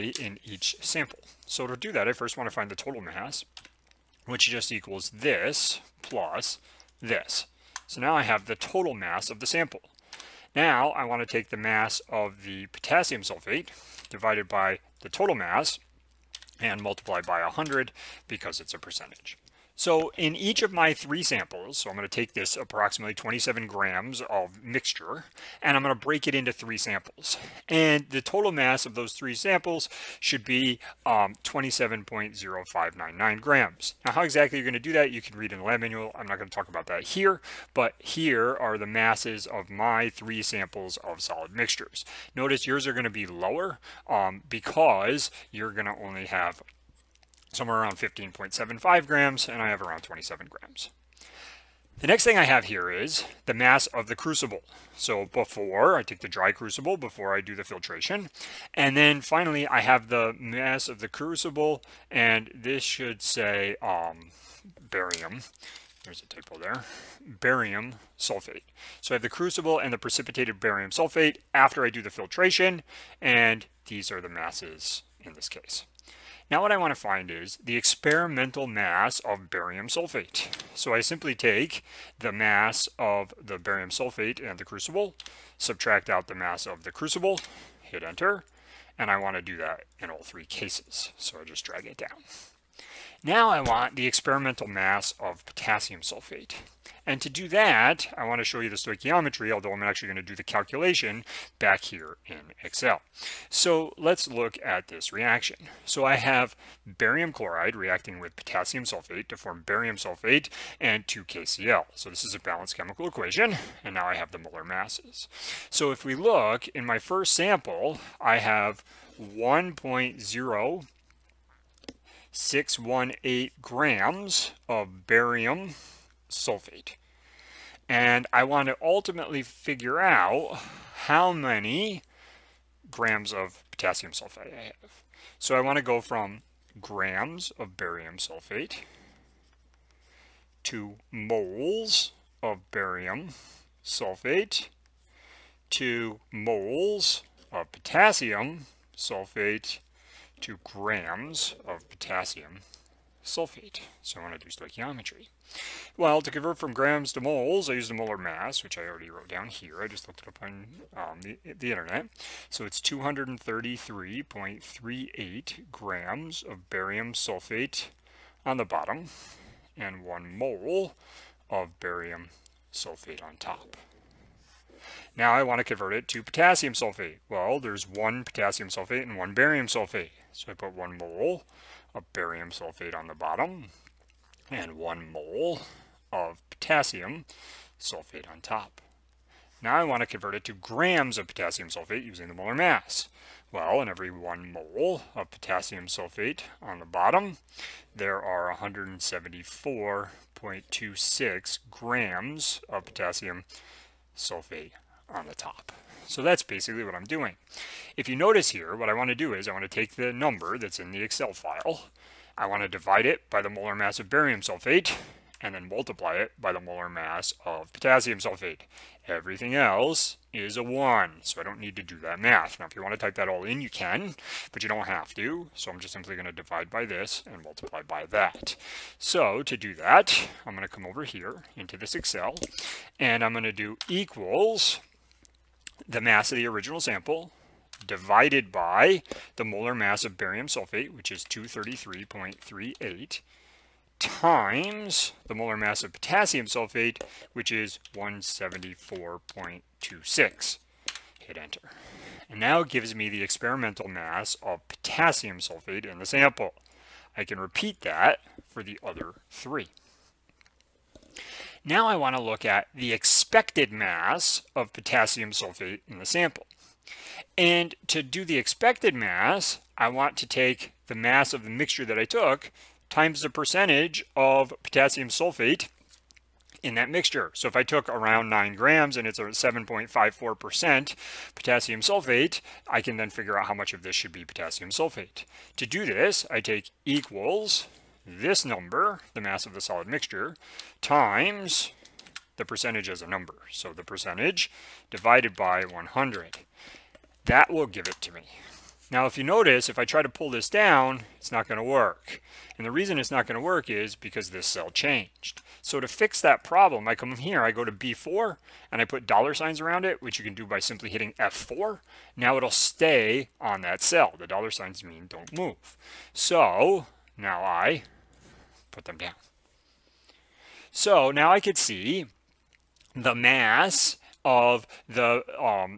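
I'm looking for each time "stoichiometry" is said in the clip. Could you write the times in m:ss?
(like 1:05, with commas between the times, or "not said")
1:38, 2:34.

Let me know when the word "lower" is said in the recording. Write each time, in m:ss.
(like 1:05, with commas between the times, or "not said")
0:43.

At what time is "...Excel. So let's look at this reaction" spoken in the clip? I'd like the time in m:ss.
1:42.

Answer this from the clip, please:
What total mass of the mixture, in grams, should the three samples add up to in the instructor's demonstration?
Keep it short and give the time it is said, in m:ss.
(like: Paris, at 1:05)
27.0599 grams, at 0:31.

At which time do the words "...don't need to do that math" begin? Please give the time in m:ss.
3:41.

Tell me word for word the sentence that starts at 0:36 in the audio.
I'm not going to talk about that here, but here are the masses of my three samples of solid mixtures.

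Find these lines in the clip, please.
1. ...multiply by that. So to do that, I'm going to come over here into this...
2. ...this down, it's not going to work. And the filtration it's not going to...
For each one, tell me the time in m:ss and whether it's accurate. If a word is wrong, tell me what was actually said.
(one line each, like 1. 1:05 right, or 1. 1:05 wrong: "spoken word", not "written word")
1. 3:47 right
2. 5:00 wrong: "reason", not "filtration".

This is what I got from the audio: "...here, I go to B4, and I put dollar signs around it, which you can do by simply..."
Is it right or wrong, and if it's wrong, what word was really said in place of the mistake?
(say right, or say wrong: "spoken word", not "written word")
right.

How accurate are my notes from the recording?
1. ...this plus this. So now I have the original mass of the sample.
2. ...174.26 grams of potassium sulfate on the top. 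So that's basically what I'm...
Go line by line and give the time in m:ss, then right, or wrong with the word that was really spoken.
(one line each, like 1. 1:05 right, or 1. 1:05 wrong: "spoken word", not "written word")
1. 0:05 wrong: "total", not "original"
2. 3:18 right.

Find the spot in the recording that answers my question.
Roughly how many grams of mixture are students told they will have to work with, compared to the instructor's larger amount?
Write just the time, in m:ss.
0:47.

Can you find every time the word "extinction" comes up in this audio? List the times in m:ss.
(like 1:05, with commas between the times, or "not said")
not said.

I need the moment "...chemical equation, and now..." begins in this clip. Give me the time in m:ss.
1:52.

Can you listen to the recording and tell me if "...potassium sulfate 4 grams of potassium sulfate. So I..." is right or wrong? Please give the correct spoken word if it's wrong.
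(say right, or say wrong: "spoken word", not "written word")
wrong: "2", not "4".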